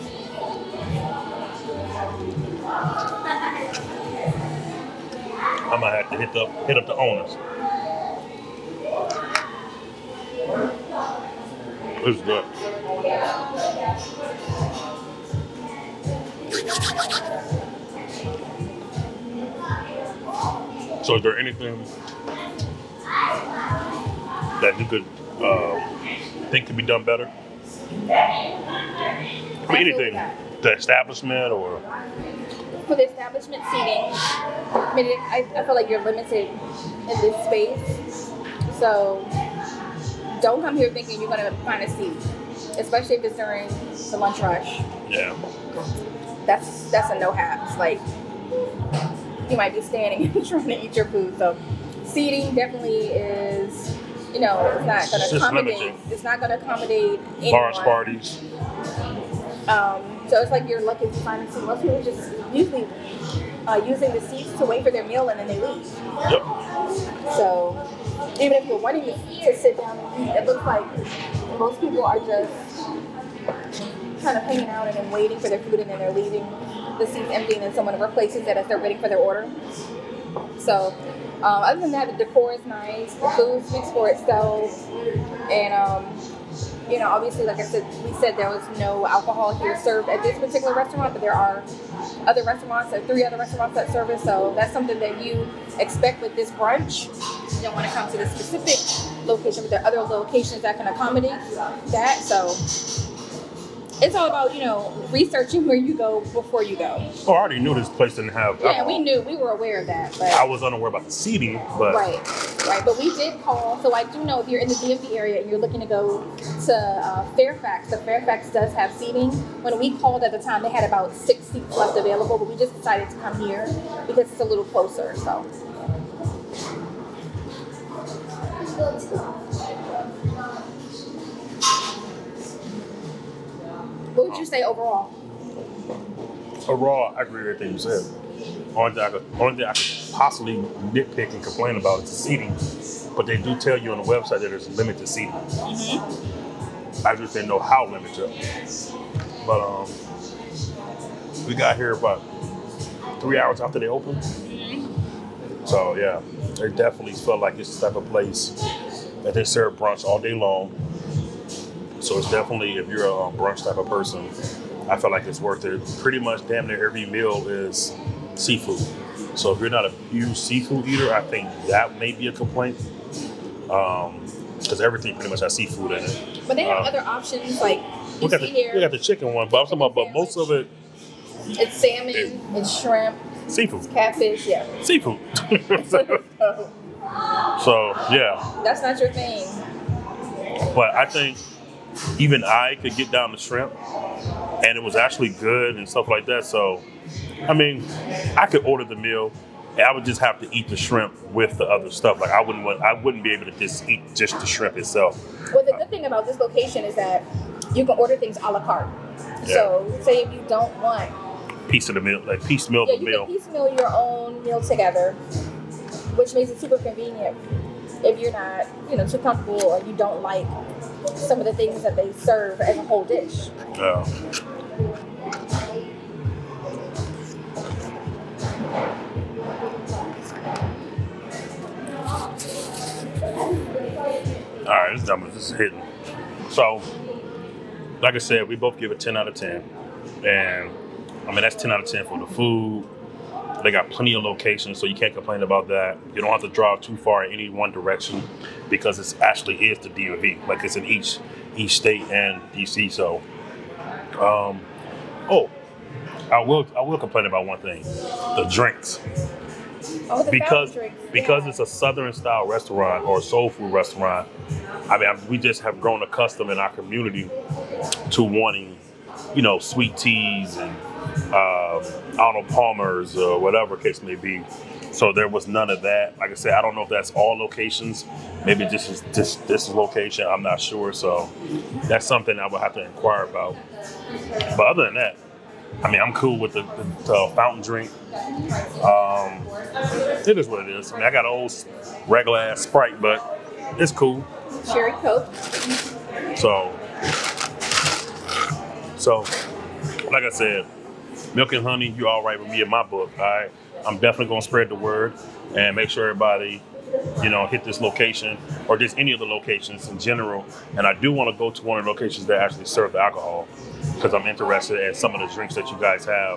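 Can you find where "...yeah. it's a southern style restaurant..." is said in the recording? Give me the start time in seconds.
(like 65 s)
261 s.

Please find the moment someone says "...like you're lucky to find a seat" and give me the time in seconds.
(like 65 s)
60 s.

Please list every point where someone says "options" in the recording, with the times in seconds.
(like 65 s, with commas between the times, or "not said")
177 s.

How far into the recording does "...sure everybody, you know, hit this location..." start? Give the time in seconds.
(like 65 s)
305 s.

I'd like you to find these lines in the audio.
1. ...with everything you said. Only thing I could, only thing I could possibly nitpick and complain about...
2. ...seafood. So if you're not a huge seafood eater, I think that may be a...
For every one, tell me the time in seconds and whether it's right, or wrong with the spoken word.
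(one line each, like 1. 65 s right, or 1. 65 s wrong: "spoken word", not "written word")
1. 137 s right
2. 168 s right.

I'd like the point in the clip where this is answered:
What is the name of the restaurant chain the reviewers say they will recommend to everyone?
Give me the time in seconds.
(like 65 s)
301 s.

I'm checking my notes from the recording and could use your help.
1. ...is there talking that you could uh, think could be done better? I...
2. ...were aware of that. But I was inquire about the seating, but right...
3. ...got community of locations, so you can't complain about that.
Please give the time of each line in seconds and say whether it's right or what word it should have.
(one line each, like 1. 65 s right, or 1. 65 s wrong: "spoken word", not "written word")
1. 21 s wrong: "anything", not "talking"
2. 109 s wrong: "unaware", not "inquire"
3. 243 s wrong: "plenty", not "community".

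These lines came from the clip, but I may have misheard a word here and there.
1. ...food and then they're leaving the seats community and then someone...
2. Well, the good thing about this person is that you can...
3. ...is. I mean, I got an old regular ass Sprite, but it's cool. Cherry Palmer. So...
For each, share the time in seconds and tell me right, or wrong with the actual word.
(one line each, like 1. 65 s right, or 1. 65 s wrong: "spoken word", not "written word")
1. 75 s wrong: "empty", not "community"
2. 205 s wrong: "location", not "person"
3. 290 s wrong: "Coke", not "Palmer".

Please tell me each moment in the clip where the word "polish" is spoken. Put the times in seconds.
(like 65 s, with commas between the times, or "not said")
not said.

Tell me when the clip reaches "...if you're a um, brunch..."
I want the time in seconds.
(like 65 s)
162 s.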